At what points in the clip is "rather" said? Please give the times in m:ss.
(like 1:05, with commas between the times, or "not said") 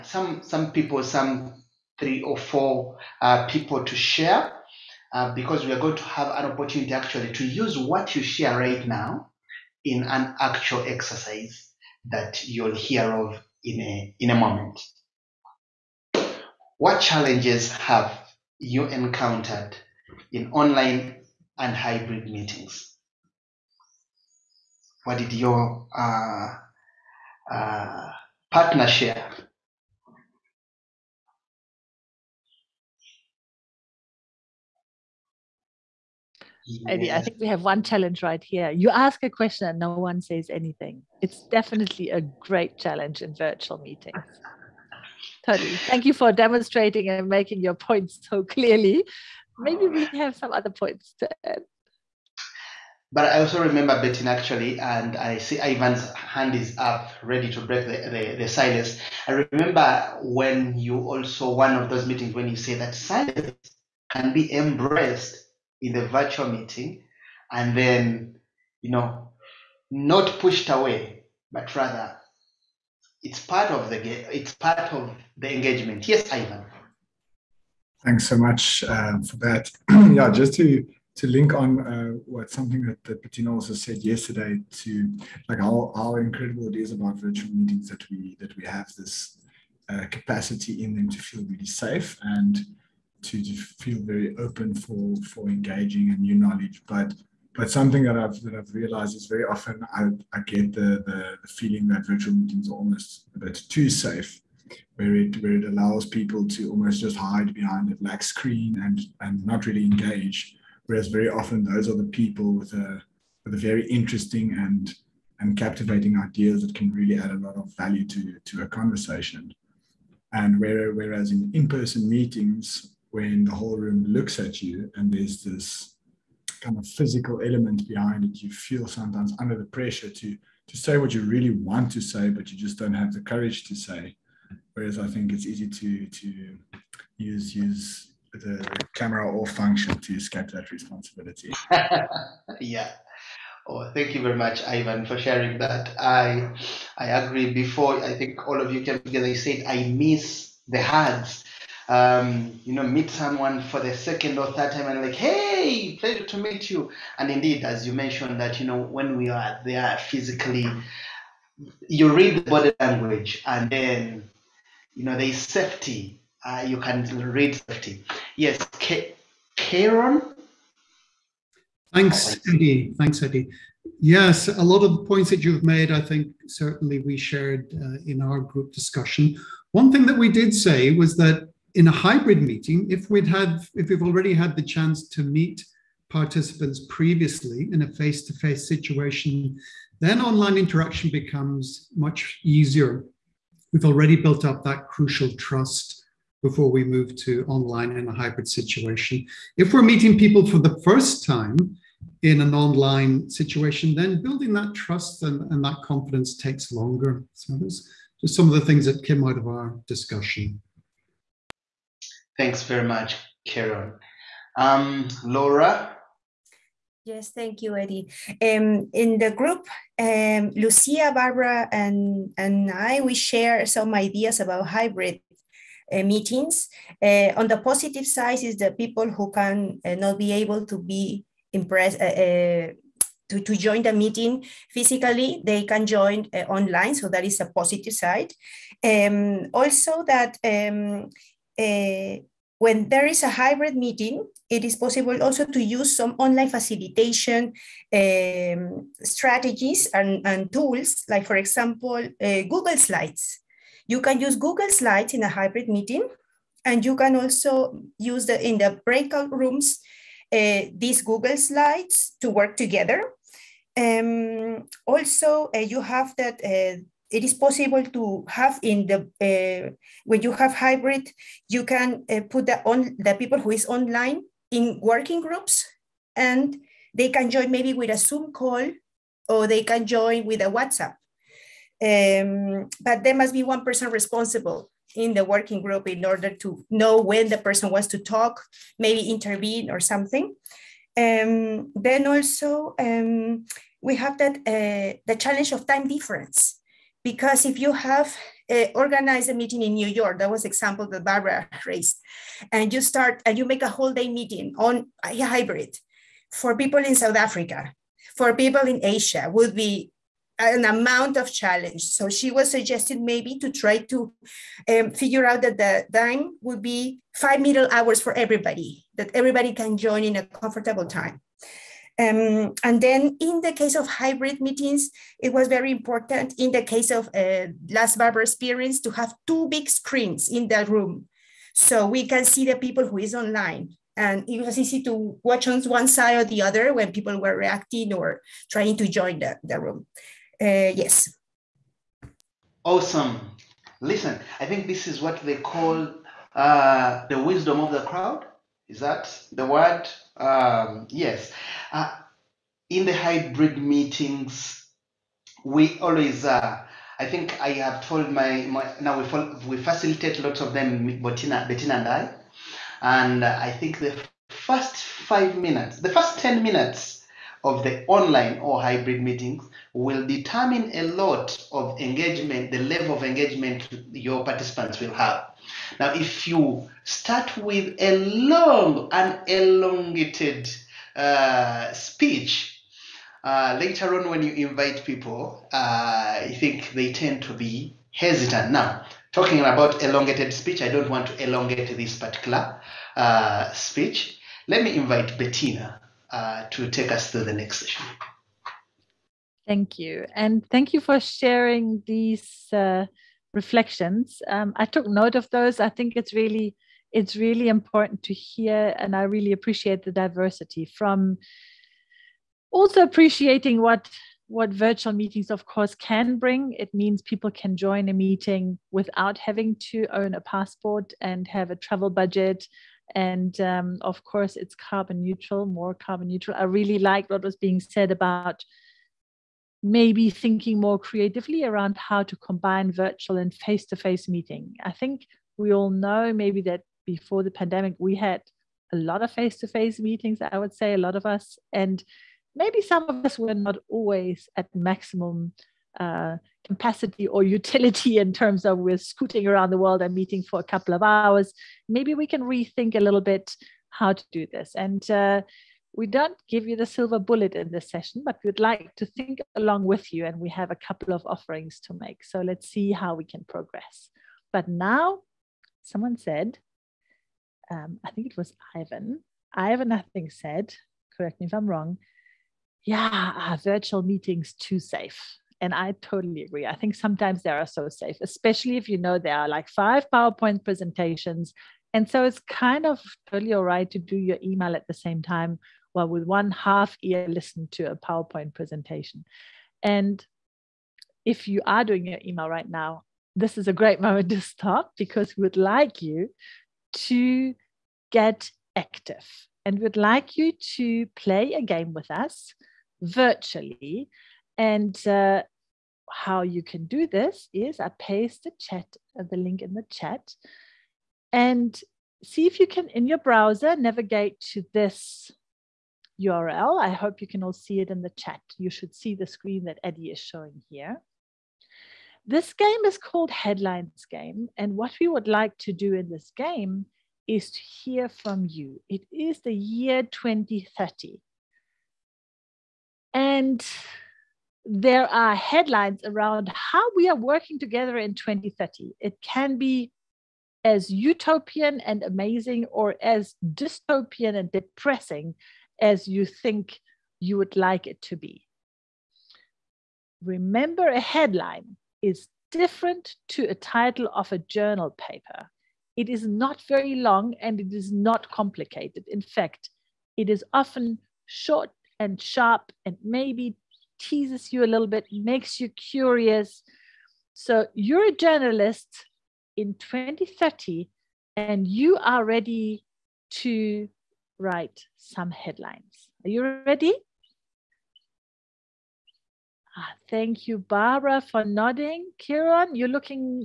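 1:11.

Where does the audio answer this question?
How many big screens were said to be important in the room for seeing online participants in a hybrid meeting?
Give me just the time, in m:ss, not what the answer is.
5:29.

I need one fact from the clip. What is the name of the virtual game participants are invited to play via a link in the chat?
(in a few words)
Headlines Game.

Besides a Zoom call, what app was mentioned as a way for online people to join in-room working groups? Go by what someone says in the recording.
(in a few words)
WhatsApp.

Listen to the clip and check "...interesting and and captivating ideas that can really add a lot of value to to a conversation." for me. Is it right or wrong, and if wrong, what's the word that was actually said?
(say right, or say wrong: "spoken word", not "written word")
right.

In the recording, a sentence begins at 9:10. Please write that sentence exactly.
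Remember, a headline is different to a title of a journal paper.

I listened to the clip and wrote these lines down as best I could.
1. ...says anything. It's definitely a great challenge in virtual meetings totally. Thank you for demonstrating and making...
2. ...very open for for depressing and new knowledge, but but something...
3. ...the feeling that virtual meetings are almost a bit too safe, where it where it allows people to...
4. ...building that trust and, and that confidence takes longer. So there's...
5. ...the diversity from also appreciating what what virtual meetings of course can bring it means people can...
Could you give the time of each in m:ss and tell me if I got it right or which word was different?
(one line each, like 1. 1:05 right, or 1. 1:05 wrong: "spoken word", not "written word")
1. 0:40 right
2. 1:34 wrong: "engaging", not "depressing"
3. 1:41 right
4. 3:24 right
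5. 6:49 right.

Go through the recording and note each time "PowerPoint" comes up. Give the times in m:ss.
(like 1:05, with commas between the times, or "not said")
7:59, 8:07.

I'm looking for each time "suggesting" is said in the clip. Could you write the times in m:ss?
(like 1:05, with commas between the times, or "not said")
5:12.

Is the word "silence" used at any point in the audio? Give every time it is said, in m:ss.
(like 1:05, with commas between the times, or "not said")
0:58, 1:02.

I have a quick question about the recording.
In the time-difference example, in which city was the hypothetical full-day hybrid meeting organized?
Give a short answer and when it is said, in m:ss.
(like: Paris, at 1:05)
New York, at 4:59.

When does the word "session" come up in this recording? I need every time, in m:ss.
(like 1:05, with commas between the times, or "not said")
6:37, 7:37.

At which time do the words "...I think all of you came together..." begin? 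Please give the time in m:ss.
2:28.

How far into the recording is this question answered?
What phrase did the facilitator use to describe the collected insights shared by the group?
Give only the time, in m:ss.
5:47.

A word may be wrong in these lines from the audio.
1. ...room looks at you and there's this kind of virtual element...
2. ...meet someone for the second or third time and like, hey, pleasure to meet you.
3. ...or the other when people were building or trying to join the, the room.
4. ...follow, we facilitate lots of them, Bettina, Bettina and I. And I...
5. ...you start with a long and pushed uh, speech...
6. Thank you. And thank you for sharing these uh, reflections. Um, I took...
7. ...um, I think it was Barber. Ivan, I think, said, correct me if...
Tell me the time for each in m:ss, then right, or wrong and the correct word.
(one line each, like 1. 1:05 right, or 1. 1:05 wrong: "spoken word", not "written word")
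1. 2:03 wrong: "physical", not "virtual"
2. 2:32 right
3. 5:36 wrong: "reacting", not "building"
4. 5:59 right
5. 6:16 wrong: "elongated", not "pushed"
6. 6:39 right
7. 7:47 wrong: "Ivan", not "Barber".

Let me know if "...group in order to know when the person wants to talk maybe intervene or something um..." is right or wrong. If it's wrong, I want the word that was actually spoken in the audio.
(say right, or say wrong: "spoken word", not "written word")
right.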